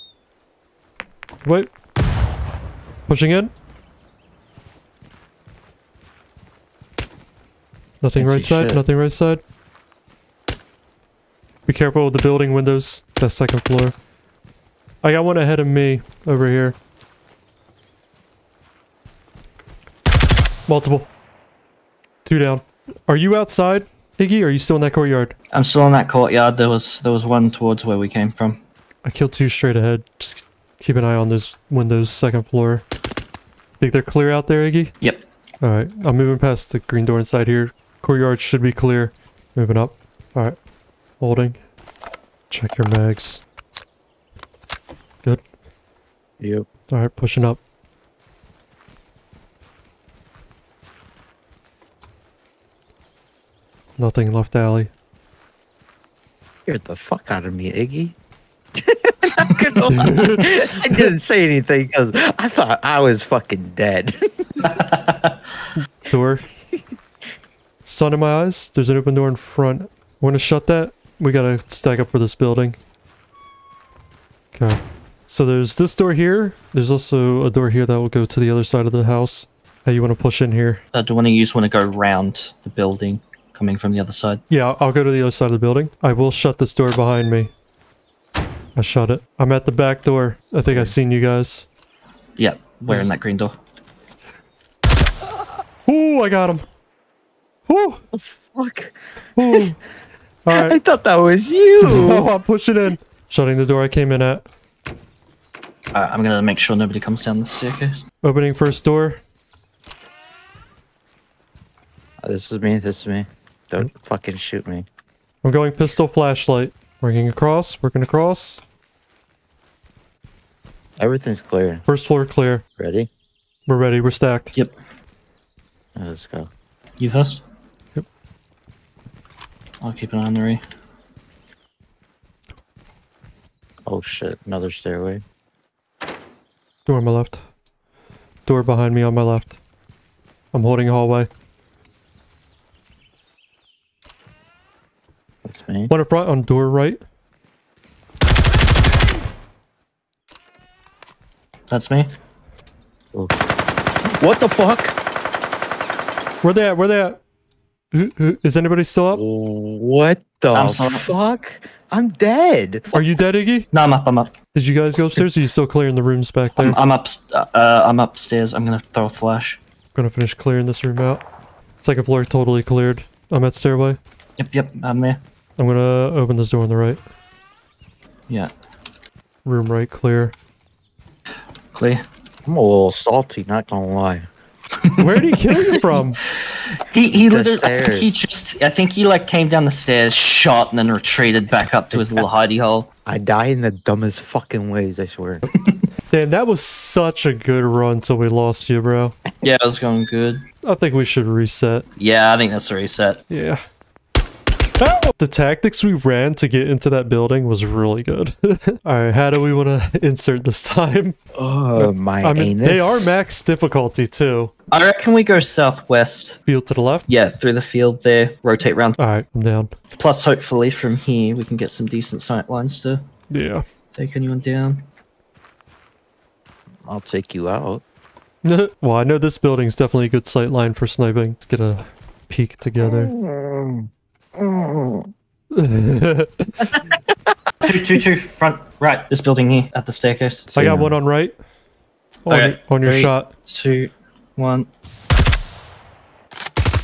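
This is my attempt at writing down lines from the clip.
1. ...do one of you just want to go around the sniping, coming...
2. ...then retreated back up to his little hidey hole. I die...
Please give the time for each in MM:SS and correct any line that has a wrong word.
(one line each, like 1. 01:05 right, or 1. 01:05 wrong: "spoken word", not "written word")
1. 01:21 wrong: "building", not "sniping"
2. 03:10 right.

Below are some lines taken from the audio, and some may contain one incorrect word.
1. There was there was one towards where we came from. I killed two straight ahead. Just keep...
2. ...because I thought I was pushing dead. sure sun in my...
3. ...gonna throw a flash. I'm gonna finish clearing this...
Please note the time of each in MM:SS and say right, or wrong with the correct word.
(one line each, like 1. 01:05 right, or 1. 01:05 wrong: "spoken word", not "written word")
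1. 00:26 right
2. 01:01 wrong: "fucking", not "pushing"
3. 02:48 right.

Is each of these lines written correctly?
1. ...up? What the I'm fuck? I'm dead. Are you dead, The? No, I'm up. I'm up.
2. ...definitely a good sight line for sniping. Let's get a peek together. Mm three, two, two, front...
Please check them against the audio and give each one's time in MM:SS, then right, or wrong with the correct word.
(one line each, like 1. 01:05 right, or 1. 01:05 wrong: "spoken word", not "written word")
1. 02:39 wrong: "Iggy", not "The"
2. 03:49 wrong: "two", not "three".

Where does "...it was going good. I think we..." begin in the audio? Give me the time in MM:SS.
03:19.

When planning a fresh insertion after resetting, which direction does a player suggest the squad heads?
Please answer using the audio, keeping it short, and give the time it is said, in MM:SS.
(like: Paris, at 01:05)
Southwest, at 03:35.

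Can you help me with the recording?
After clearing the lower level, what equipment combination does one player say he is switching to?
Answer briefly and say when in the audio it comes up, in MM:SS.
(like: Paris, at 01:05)
Pistol flashlight, at 01:55.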